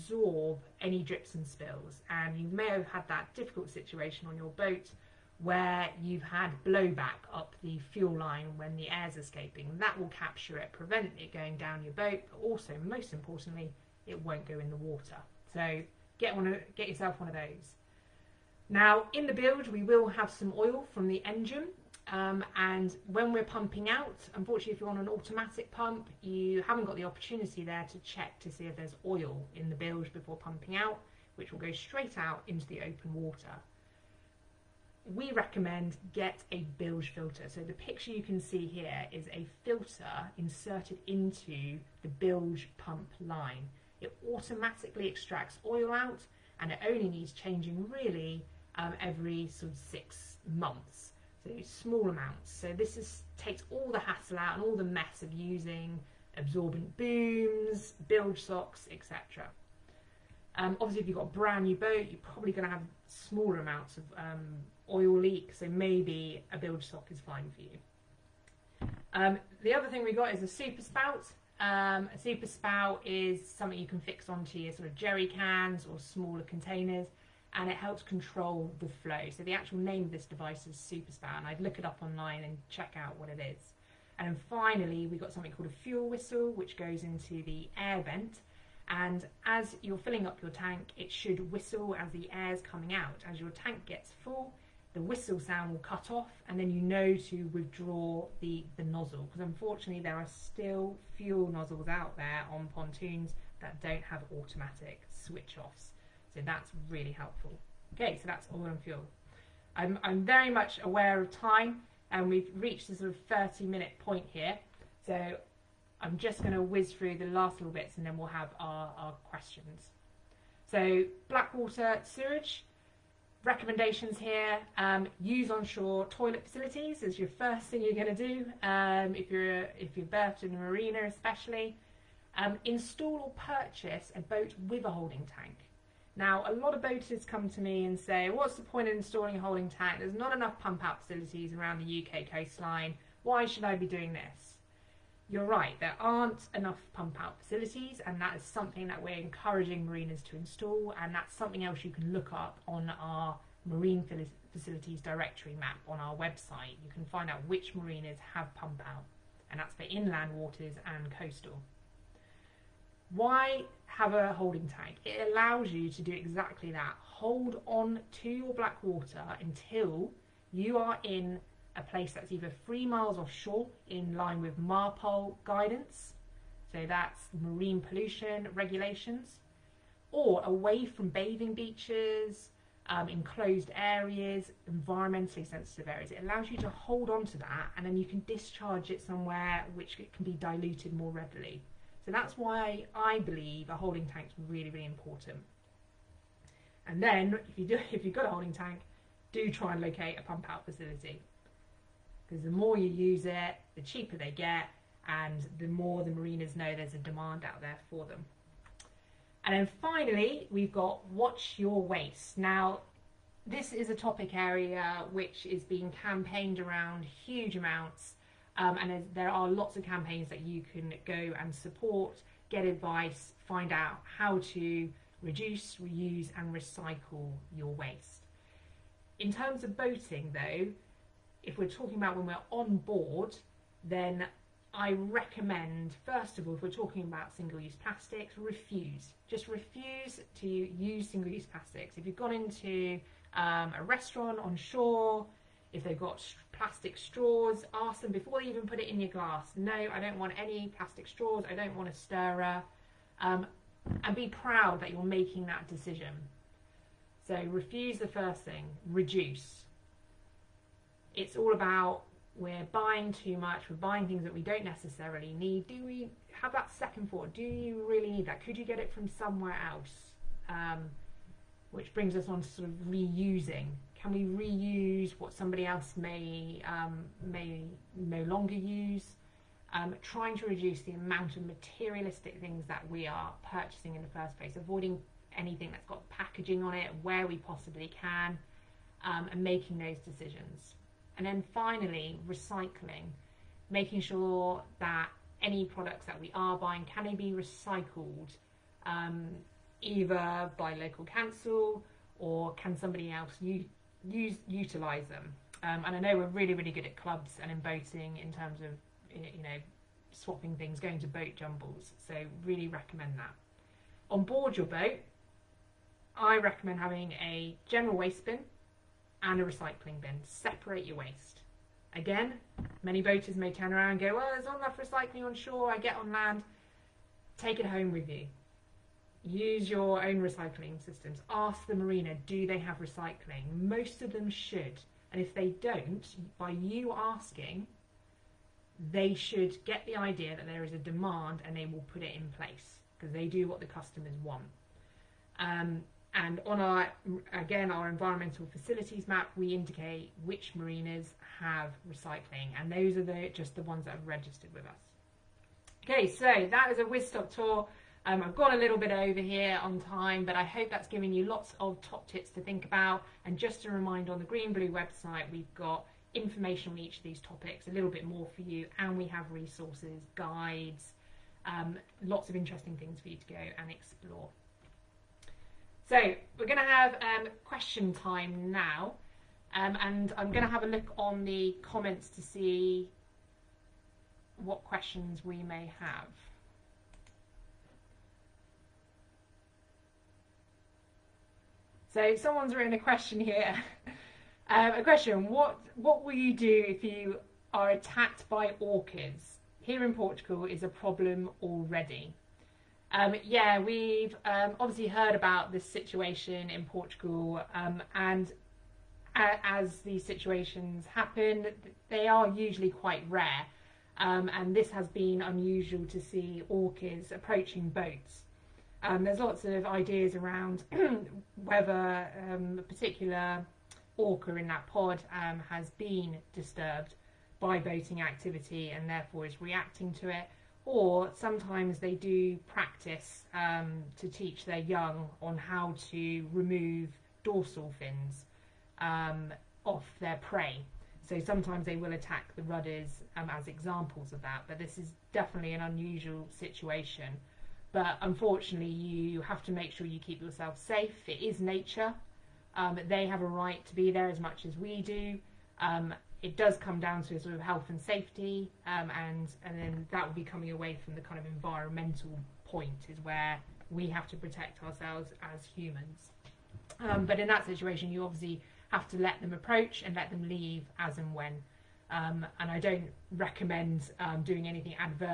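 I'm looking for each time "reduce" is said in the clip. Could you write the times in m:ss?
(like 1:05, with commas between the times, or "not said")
3:45, 4:18, 4:40.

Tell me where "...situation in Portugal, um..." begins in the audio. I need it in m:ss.
6:45.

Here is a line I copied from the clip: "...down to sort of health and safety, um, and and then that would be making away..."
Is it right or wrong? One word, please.
wrong.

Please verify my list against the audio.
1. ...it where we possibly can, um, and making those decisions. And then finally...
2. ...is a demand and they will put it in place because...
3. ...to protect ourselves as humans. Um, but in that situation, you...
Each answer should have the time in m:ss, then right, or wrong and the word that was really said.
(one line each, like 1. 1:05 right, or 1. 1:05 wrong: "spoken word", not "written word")
1. 4:46 right
2. 5:40 right
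3. 7:44 right.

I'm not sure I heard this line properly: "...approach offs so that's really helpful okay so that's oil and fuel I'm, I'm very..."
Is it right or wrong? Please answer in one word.
wrong.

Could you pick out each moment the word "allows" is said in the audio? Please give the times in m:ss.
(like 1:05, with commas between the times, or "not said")
2:45, 3:06.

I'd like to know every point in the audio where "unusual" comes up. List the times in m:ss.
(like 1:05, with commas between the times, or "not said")
6:55, 7:25.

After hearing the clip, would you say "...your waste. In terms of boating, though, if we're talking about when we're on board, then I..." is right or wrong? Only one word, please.
right.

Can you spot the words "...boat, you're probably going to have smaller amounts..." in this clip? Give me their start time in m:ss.
1:01.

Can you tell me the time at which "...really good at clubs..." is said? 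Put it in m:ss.
5:06.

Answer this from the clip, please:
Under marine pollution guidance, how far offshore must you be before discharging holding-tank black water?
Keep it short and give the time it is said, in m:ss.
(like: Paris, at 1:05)
3 miles, at 2:52.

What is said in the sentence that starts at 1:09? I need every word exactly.
Um, the other thing we got is a super spout.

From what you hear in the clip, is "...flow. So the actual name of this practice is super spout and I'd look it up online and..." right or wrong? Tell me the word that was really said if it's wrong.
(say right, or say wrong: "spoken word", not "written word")
wrong: "device", not "practice".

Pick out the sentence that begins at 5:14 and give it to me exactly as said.
On board your boat, I recommend having a general waste bin and a recycling bin.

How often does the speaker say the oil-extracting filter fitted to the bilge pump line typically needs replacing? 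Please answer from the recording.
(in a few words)
every 6 months.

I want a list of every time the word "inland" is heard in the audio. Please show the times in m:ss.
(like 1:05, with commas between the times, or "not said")
2:39.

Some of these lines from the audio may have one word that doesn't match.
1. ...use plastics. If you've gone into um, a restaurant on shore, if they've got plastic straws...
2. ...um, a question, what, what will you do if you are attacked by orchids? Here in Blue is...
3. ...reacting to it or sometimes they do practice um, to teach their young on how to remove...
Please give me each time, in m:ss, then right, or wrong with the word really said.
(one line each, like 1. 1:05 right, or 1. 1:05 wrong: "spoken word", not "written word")
1. 4:01 right
2. 6:34 wrong: "Portugal", not "Blue"
3. 7:09 right.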